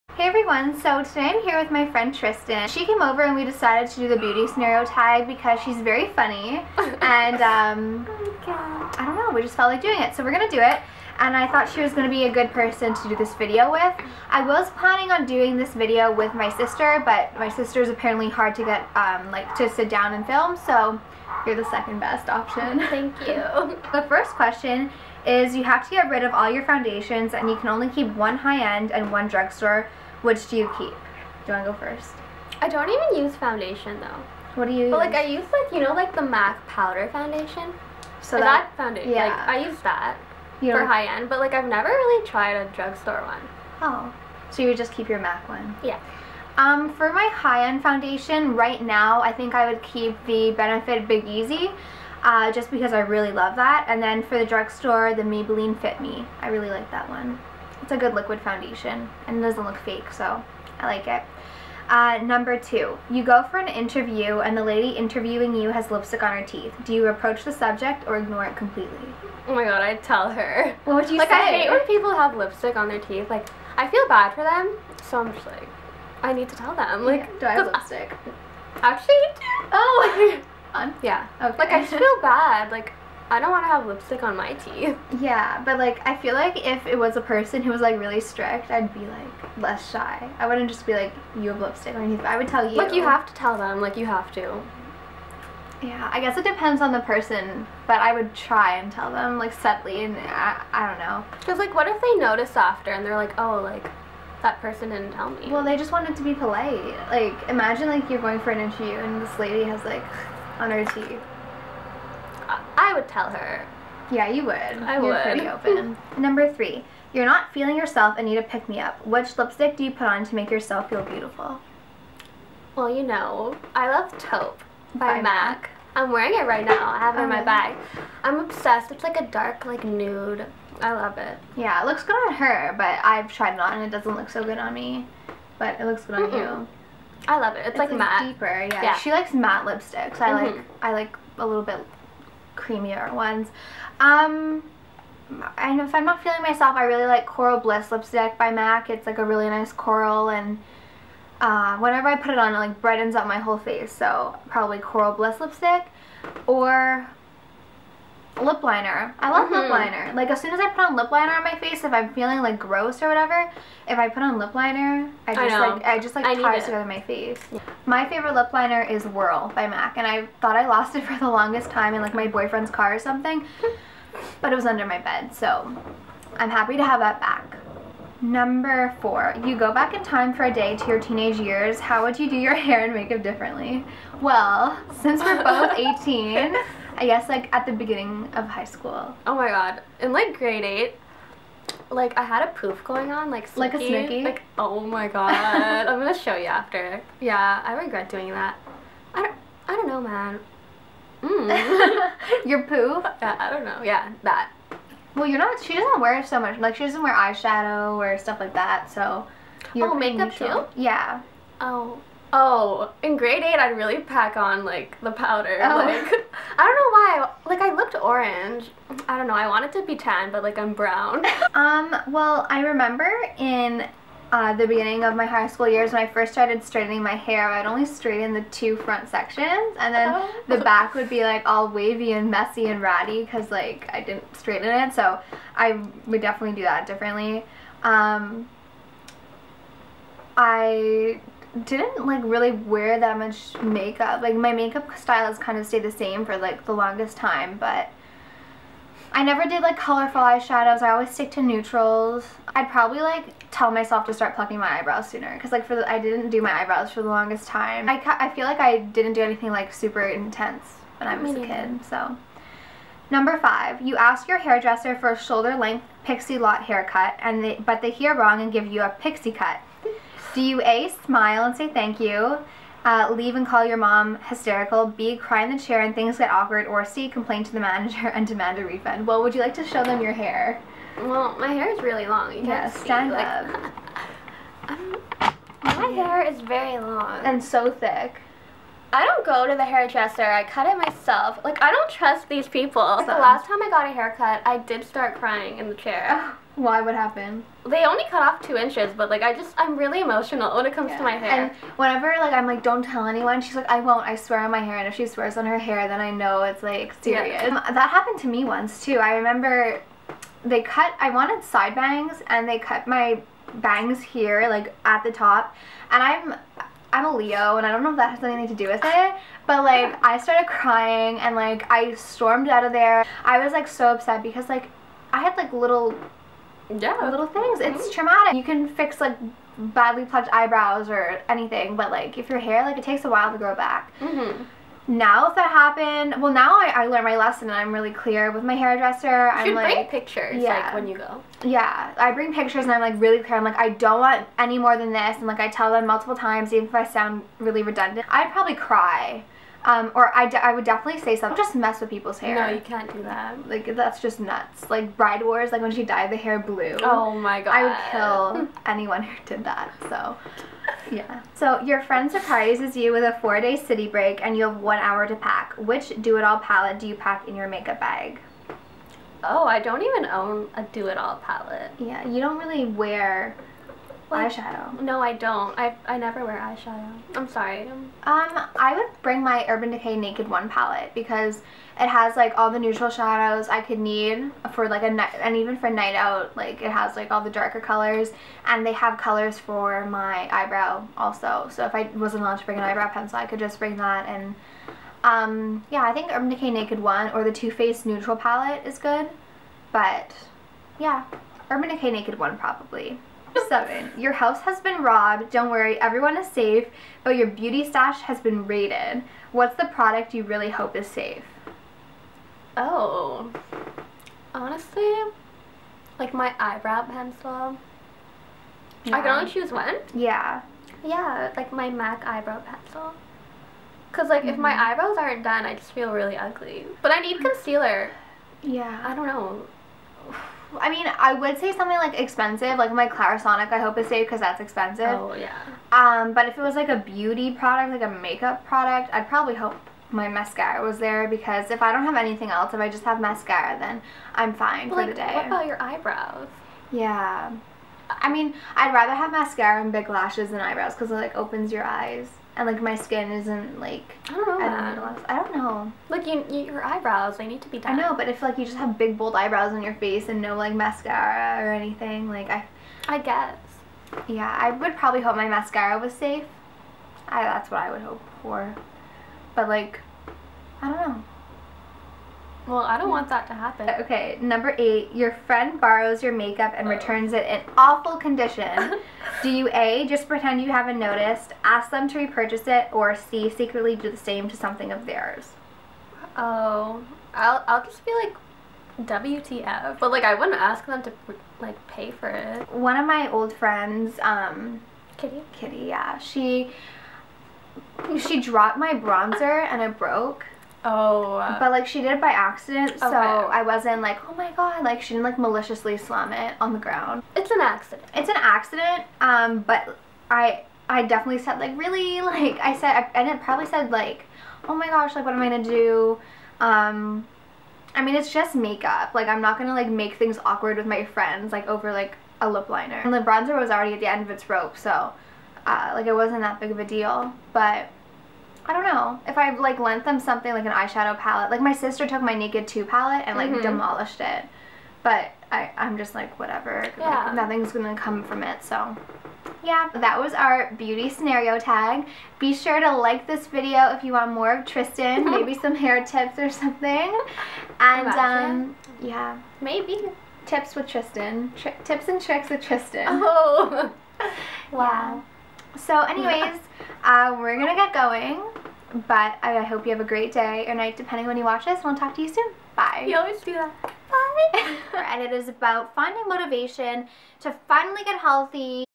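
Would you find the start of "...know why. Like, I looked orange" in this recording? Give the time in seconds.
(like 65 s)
217 s.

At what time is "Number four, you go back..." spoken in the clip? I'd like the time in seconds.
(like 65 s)
178 s.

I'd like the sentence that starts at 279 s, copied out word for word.
Well, would you like to show them your hair?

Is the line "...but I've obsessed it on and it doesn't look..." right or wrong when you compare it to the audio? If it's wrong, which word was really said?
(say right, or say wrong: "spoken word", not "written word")
wrong: "tried", not "obsessed".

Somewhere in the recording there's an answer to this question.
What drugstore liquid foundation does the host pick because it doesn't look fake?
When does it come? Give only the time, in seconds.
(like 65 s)
55 s.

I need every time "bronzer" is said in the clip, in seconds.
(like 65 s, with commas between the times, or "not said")
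498 s, 522 s.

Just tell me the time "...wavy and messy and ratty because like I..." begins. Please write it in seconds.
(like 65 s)
231 s.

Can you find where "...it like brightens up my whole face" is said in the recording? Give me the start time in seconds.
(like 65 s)
152 s.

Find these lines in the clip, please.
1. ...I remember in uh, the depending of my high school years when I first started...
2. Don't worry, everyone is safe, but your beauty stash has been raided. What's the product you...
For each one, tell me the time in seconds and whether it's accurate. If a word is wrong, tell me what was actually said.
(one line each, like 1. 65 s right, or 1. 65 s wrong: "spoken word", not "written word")
1. 222 s wrong: "beginning", not "depending"
2. 405 s right.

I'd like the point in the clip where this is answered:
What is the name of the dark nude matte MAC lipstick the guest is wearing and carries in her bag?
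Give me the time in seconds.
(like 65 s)
124 s.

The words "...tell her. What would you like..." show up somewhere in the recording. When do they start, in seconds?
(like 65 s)
70 s.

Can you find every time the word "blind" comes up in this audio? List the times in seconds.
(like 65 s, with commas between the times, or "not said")
not said.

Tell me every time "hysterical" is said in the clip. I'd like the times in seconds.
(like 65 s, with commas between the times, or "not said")
274 s.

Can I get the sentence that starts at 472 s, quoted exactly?
Well, I don't want that to happen.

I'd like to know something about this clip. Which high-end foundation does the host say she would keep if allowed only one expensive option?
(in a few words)
Benefit Big Easy.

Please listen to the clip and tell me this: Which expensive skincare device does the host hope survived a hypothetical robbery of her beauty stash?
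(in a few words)
Clarisonic.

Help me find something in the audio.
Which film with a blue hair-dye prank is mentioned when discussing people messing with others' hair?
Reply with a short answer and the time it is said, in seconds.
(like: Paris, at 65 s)
Bride Wars, at 354 s.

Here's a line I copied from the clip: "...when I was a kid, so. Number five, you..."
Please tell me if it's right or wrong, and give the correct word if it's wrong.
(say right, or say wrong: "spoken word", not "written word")
right.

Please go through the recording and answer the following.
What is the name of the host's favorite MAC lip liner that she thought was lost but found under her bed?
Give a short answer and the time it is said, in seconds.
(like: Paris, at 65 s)
Whirl, at 169 s.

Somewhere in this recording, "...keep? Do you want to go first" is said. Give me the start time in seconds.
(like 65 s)
30 s.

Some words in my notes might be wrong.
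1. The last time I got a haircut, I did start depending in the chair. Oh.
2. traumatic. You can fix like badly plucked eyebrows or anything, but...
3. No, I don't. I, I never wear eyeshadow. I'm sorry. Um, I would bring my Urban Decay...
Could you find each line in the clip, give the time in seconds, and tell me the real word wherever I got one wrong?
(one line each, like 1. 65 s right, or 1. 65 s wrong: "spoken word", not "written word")
1. 292 s wrong: "crying", not "depending"
2. 328 s right
3. 374 s right.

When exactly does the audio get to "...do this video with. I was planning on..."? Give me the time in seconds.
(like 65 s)
13 s.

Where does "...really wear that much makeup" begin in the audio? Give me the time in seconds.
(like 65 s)
242 s.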